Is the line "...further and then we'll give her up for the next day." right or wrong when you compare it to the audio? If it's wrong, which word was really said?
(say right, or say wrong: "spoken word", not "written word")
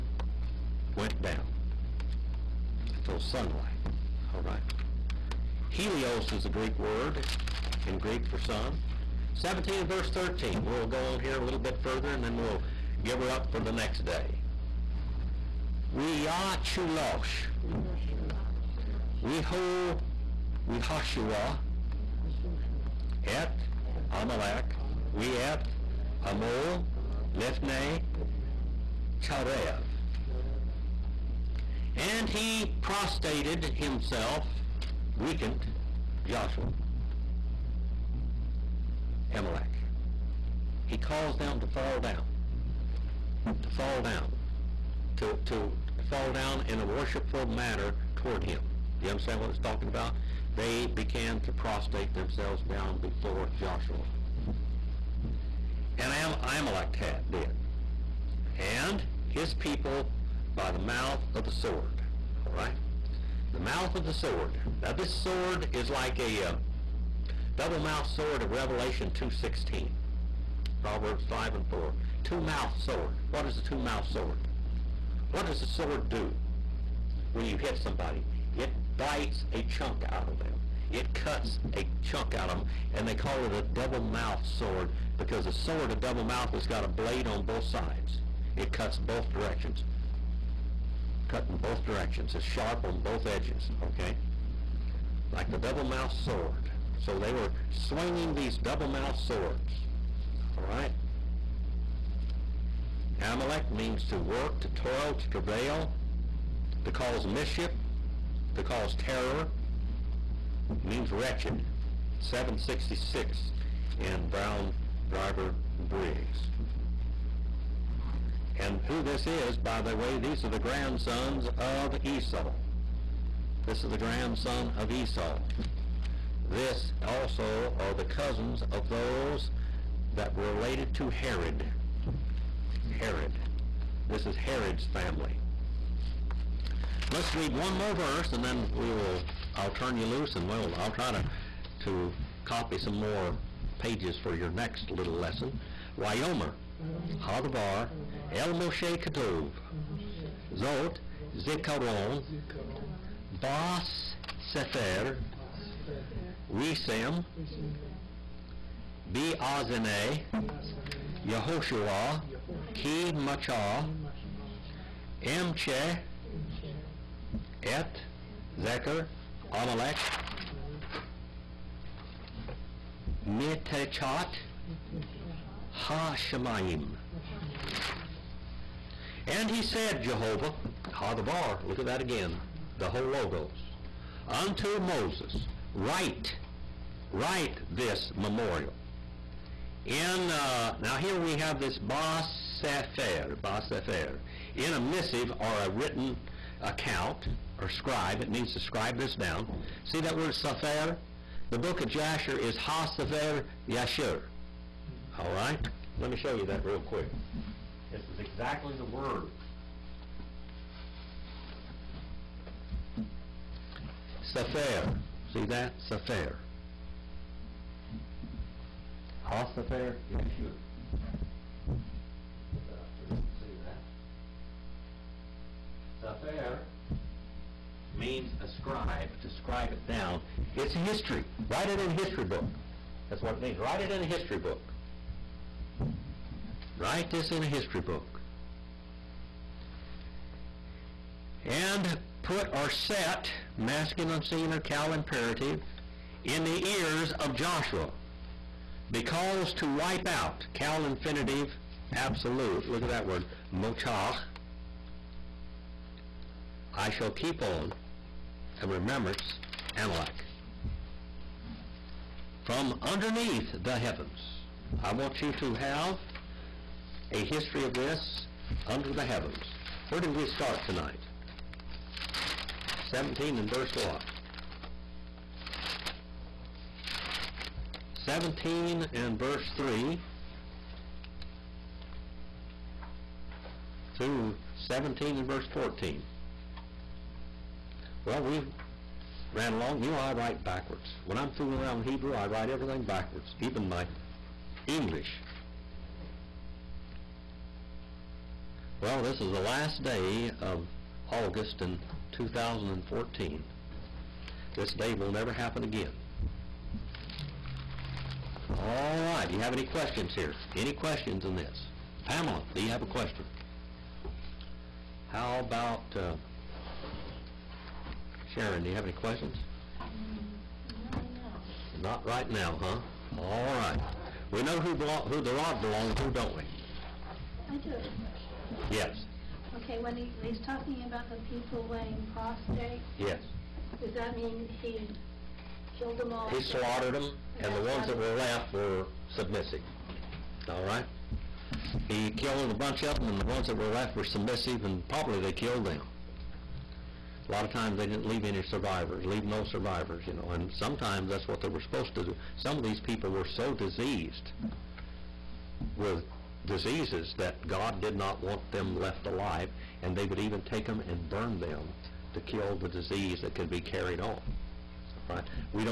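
right.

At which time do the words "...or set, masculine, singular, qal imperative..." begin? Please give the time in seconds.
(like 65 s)
242 s.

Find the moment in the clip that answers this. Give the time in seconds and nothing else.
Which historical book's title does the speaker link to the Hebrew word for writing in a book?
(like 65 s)
201 s.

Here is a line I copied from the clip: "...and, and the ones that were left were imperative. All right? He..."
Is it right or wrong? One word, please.
wrong.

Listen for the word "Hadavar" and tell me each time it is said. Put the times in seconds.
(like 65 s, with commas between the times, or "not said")
147 s, 180 s.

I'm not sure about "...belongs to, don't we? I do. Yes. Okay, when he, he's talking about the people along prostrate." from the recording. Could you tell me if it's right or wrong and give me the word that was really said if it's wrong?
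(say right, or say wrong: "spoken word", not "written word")
wrong: "laying", not "along".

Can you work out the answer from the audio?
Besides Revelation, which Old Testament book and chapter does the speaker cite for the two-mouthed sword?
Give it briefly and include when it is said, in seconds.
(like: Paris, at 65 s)
Proverbs 5, at 70 s.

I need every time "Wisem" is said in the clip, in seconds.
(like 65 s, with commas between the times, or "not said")
156 s.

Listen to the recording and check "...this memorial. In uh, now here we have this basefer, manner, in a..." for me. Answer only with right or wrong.
wrong.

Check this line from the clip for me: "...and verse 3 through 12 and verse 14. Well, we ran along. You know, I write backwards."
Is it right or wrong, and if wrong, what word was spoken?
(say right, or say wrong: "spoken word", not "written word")
wrong: "17", not "12".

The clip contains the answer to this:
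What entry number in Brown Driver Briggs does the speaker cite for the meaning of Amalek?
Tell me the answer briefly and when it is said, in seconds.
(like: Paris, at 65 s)
766, at 112 s.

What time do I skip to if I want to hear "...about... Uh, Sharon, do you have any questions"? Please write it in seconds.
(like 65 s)
315 s.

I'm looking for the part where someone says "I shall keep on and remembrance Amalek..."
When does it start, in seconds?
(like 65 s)
256 s.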